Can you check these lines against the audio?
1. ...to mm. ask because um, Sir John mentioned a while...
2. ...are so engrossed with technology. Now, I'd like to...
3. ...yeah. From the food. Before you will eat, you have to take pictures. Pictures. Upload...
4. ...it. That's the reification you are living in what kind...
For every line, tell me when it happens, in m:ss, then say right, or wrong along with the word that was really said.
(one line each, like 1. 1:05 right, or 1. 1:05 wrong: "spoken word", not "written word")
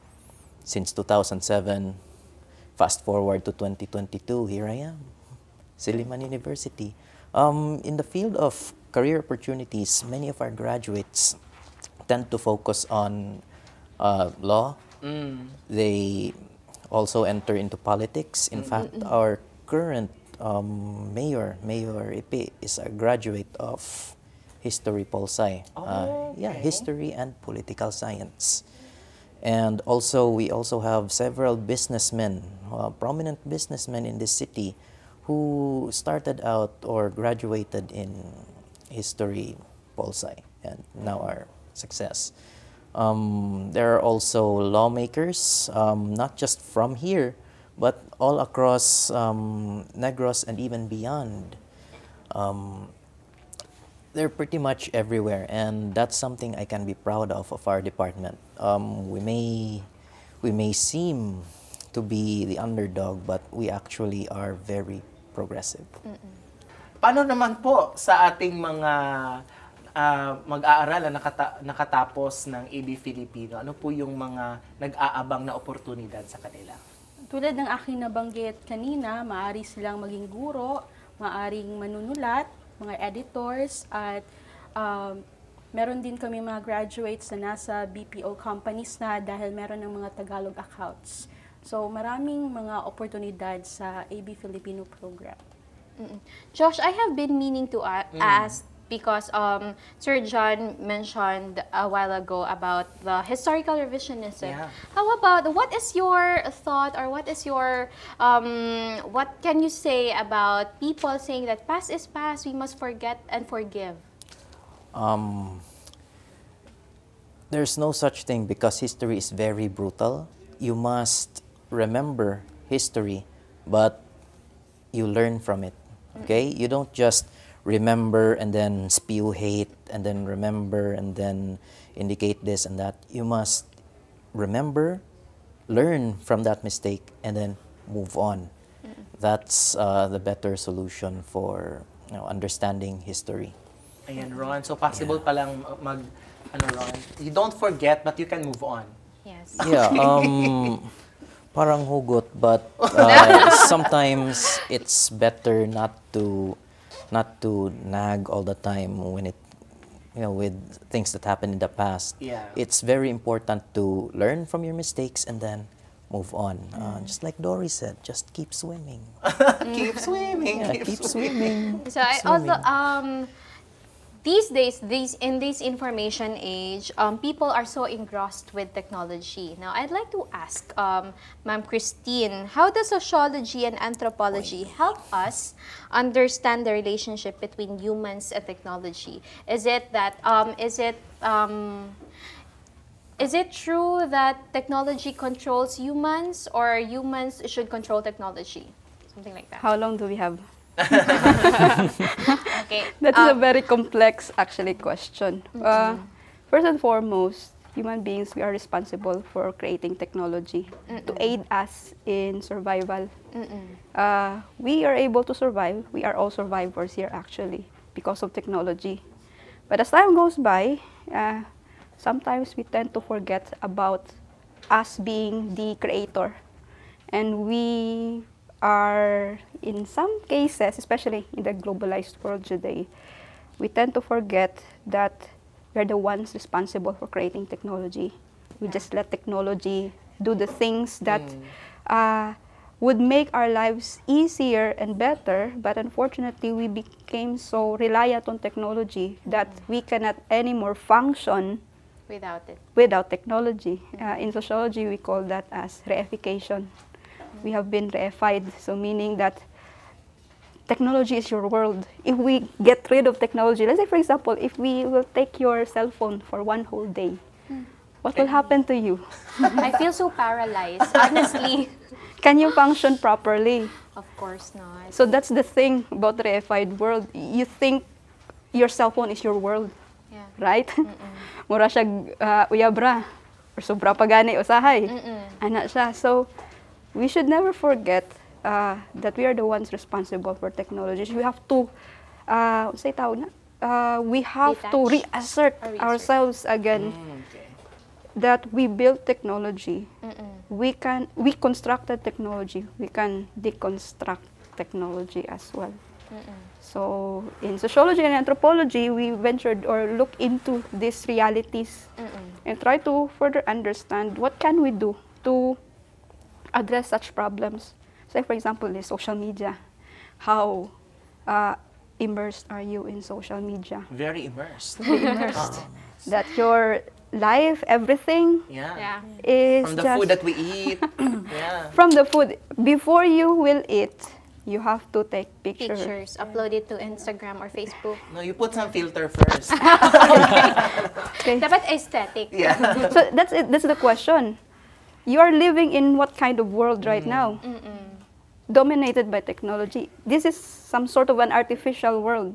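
1. 1:37 right
2. 2:57 right
3. 5:30 right
4. 5:43 wrong: "question", not "reification".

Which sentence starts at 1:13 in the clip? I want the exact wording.
Ano po yung mga nag-aabang na oportunidad sa kanila?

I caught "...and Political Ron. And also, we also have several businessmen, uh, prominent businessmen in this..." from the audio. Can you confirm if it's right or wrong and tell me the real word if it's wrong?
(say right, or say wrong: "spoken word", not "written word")
wrong: "Science", not "Ron".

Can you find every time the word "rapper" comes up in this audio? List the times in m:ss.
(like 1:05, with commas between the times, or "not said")
not said.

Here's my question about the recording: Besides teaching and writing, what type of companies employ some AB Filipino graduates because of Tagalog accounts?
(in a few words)
BPO companies.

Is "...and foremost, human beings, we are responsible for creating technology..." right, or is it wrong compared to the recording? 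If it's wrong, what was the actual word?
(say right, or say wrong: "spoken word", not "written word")
right.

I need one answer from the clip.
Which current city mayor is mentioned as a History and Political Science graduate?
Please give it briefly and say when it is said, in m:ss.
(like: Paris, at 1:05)
Mayor Ipe, at 0:21.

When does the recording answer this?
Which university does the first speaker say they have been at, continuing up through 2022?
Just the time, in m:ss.
0:05.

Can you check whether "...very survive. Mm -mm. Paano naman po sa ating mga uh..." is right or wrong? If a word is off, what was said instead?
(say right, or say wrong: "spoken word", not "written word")
wrong: "progressive", not "survive".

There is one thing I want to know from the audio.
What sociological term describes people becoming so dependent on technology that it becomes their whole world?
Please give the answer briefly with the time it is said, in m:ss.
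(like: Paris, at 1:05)
reification, at 4:15.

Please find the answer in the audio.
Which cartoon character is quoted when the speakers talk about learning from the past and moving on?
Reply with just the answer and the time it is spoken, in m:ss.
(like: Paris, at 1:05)
Dory, at 2:47.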